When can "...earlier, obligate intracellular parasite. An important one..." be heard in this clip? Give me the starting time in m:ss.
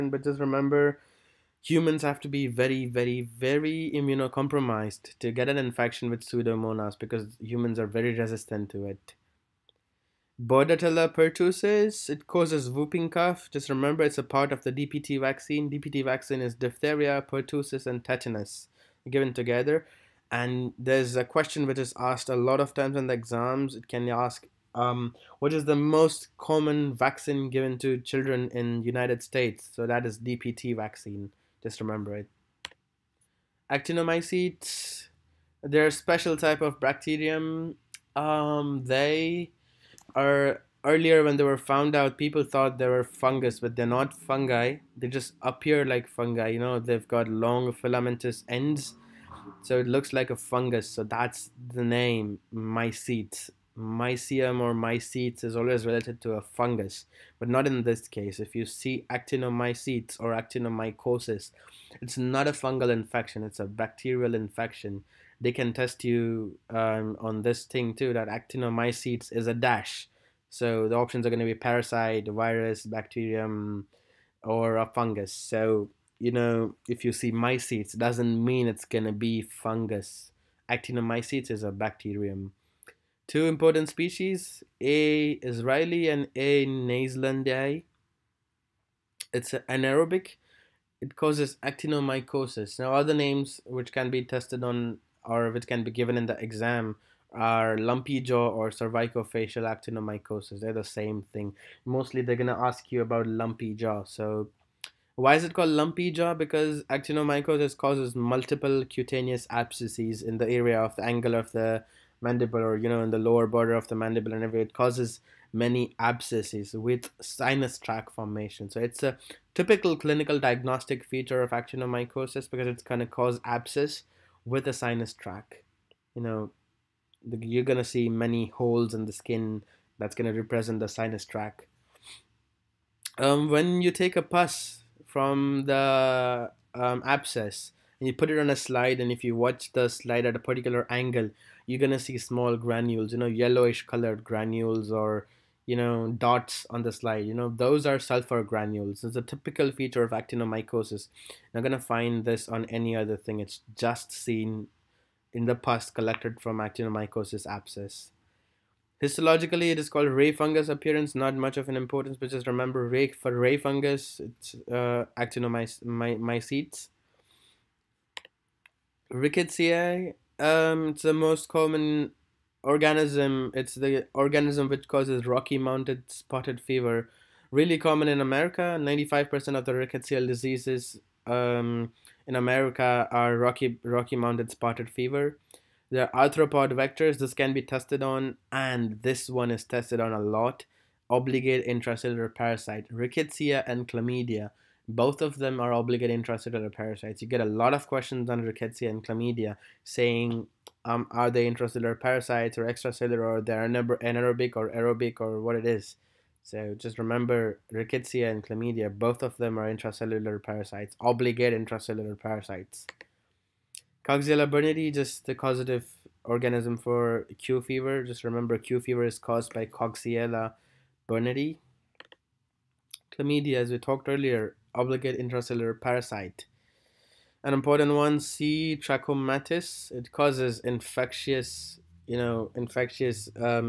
3:44.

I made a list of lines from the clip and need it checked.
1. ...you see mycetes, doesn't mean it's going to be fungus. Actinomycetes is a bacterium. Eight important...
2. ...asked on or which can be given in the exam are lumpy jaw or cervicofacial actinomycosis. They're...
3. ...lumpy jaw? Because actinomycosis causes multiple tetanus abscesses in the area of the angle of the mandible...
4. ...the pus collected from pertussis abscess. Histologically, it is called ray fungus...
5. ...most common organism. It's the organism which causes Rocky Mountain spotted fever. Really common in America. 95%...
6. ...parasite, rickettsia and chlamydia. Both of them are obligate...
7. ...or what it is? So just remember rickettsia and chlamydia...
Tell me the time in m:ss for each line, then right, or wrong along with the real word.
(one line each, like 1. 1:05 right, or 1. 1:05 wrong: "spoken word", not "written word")
1. 1:17 wrong: "Two", not "Eight"
2. 1:34 wrong: "tested", not "asked"
3. 1:45 wrong: "cutaneous", not "tetanus"
4. 2:35 wrong: "actinomycosis", not "pertussis"
5. 2:51 right
6. 3:12 right
7. 3:25 right.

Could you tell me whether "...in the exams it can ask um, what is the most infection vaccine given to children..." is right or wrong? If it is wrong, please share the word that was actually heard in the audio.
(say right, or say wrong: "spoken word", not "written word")
wrong: "common", not "infection".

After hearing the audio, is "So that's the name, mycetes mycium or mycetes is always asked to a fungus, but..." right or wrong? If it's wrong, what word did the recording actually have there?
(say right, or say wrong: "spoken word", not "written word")
wrong: "related", not "asked".